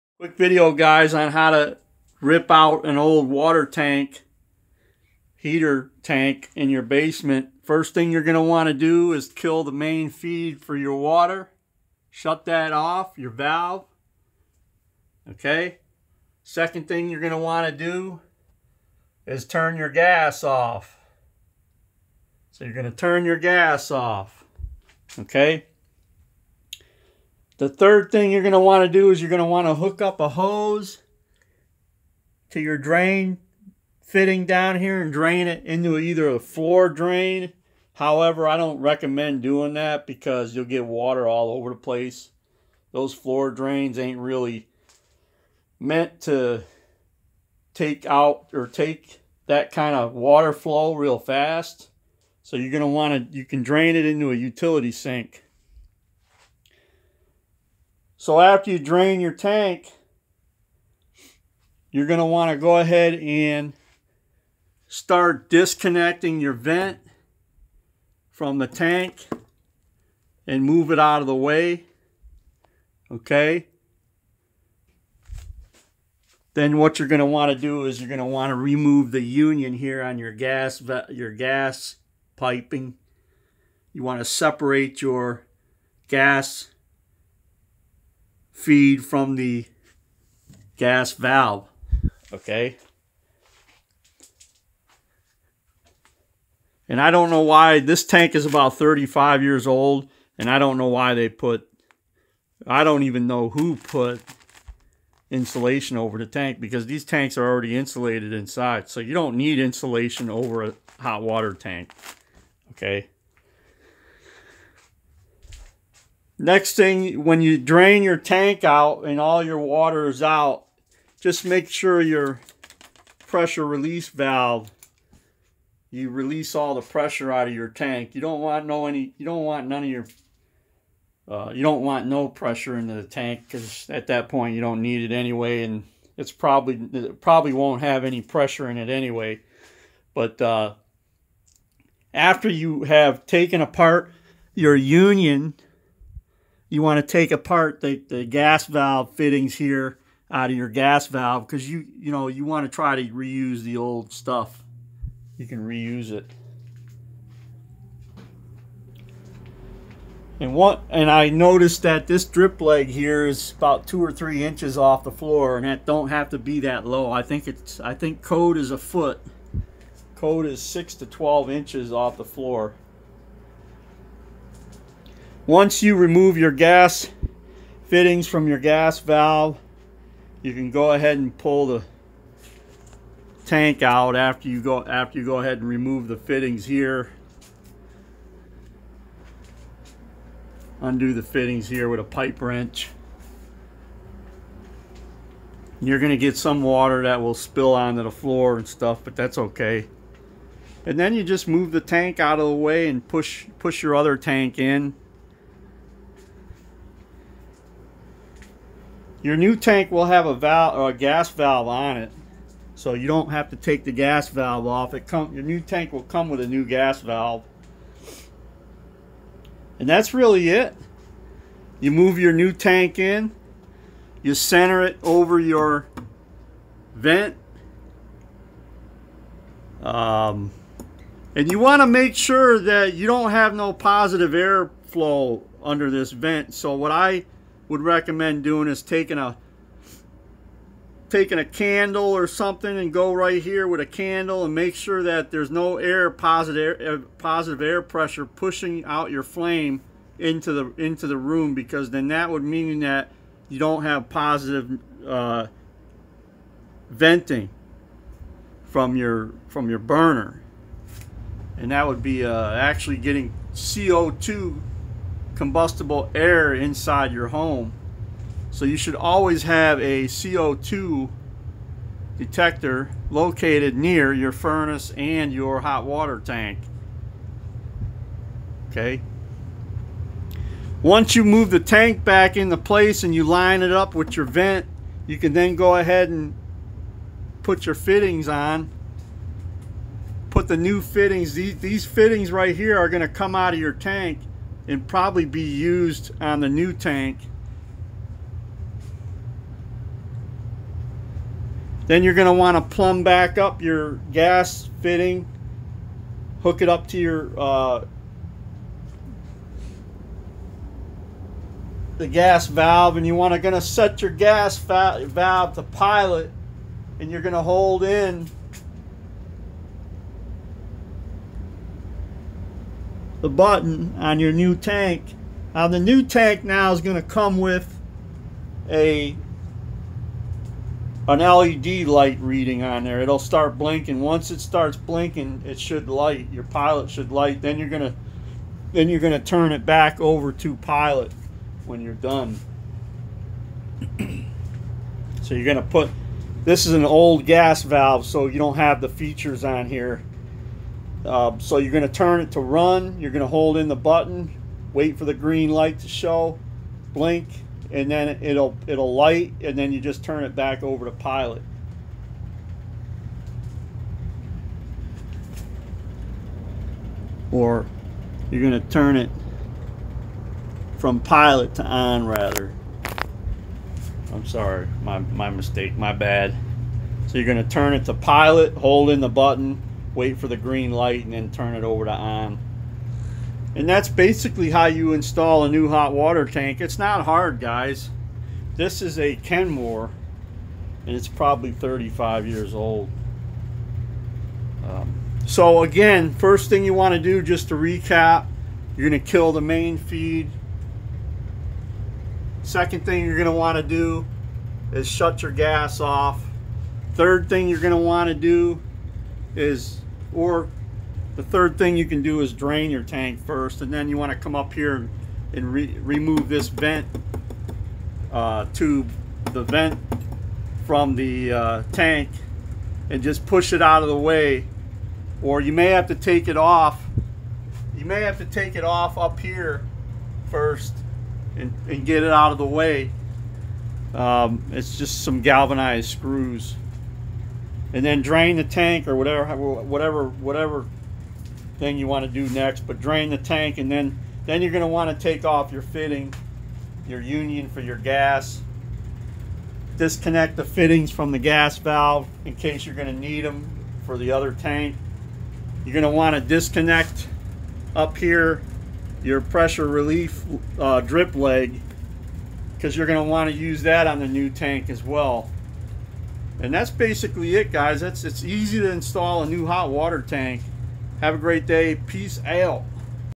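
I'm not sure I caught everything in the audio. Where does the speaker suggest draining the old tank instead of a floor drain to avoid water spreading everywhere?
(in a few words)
utility sink.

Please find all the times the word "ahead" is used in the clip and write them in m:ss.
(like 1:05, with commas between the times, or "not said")
1:02, 3:00, 3:05, 4:45.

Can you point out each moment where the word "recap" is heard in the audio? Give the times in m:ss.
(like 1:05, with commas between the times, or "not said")
6:37.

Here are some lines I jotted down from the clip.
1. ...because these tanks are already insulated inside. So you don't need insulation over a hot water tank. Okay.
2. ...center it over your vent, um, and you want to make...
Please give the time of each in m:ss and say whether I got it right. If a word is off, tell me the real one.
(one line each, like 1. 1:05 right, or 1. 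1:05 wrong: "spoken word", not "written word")
1. 1:46 right
2. 3:44 right.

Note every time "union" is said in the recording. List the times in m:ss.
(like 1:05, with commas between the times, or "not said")
1:19, 2:24, 7:27.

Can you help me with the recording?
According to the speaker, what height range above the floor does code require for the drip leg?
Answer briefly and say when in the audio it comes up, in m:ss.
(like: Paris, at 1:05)
6 to 12 inches, at 2:50.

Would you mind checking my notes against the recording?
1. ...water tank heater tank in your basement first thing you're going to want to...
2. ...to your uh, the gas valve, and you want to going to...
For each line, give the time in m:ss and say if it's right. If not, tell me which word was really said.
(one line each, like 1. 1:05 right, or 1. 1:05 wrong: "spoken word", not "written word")
1. 0:03 right
2. 5:06 right.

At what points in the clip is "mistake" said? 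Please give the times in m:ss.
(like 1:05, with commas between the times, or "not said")
6:15.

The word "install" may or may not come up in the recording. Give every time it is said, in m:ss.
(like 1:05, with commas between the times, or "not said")
6:24, 7:48.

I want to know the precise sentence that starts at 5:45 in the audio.
so you're gonna put this is an old gas valve, so you don't have the features on here.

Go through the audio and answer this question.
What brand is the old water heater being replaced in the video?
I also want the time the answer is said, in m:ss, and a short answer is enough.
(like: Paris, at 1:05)
Kenmore, at 6:29.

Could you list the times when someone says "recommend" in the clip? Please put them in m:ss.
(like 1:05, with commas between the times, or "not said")
0:38, 3:57.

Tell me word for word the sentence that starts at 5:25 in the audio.
Now the new tank now is going to come with a an LED light reading on there.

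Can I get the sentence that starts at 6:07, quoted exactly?
Or you're going to turn it from pilot to on rather.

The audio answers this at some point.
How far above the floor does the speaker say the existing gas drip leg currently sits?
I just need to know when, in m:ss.
2:43.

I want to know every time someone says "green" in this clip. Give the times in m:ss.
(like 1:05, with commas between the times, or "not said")
5:55, 6:20.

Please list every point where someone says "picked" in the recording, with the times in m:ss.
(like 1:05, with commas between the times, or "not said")
not said.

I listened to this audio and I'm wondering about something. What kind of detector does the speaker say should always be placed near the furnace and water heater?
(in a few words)
CO2 detector.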